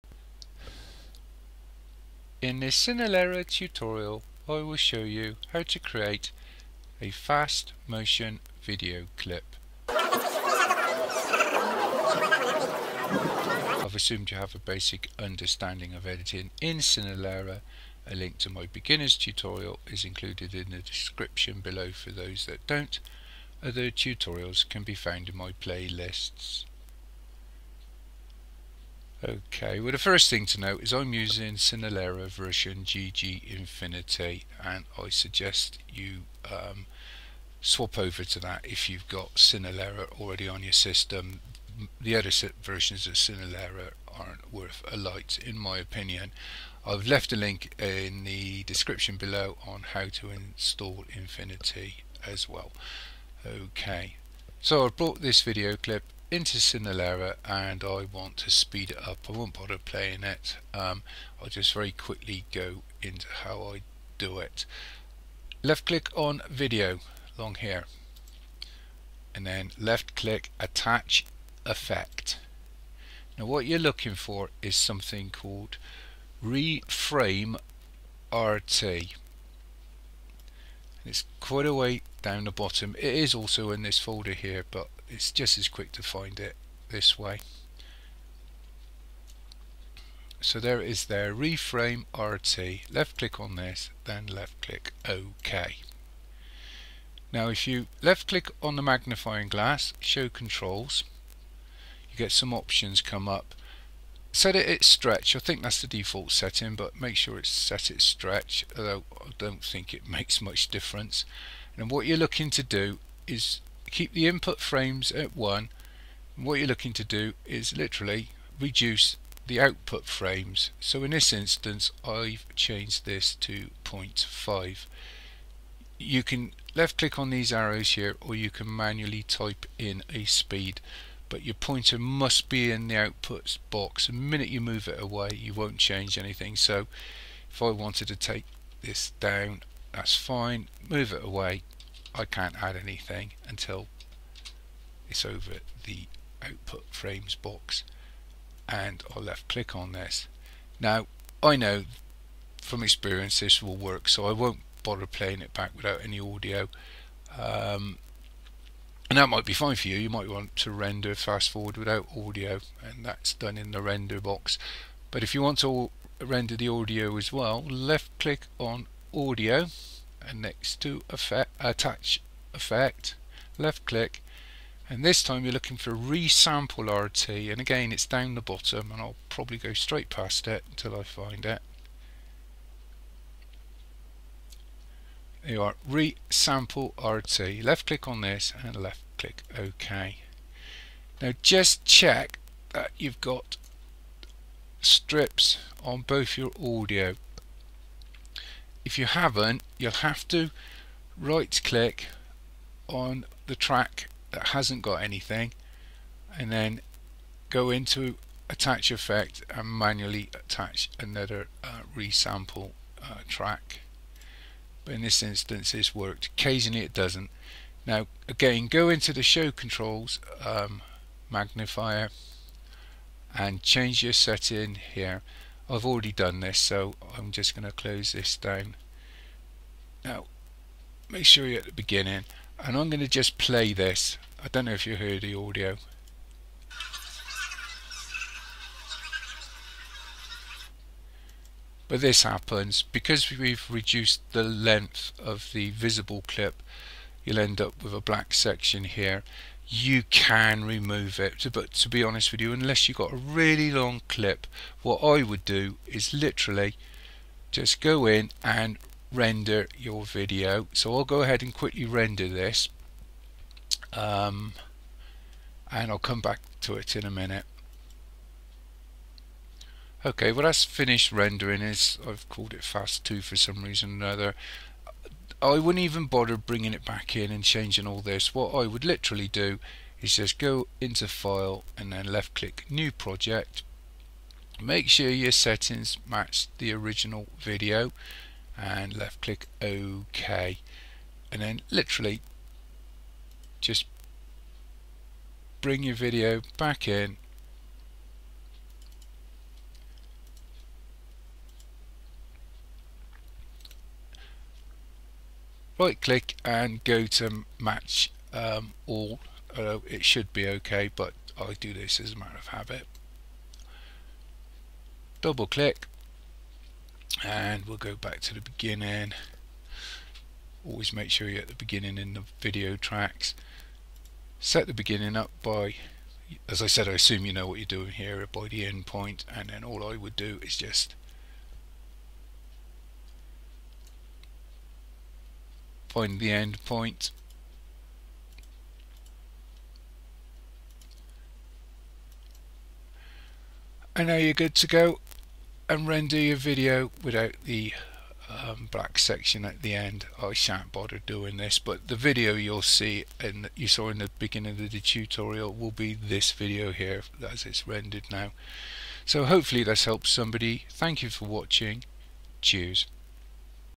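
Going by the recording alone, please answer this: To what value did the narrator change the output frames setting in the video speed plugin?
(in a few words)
0.5.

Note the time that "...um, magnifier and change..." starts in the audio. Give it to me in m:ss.
3:40.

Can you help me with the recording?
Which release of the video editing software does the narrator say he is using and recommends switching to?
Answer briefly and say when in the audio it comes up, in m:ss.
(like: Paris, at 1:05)
GG Infinity, at 0:32.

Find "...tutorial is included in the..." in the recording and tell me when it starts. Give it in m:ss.
0:19.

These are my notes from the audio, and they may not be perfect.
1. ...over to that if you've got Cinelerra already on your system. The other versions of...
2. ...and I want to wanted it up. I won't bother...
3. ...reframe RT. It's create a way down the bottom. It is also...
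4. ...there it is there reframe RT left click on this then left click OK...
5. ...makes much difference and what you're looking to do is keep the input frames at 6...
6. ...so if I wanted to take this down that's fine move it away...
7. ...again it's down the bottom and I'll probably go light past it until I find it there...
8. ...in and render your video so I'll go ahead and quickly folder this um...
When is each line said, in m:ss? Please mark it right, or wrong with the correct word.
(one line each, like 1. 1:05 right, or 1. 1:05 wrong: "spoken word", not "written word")
1. 0:37 right
2. 0:57 wrong: "speed", not "wanted"
3. 1:16 wrong: "quite", not "create"
4. 1:30 right
5. 1:50 wrong: "1", not "6"
6. 2:16 right
7. 2:57 wrong: "straight", not "light"
8. 4:18 wrong: "render", not "folder".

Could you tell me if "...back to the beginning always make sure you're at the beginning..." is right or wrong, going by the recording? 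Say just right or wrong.
right.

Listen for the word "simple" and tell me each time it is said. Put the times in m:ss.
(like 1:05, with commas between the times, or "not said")
not said.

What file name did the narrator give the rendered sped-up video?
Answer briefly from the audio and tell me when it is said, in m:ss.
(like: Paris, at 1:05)
fast 2, at 4:32.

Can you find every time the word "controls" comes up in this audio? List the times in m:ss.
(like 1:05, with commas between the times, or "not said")
1:40, 3:39.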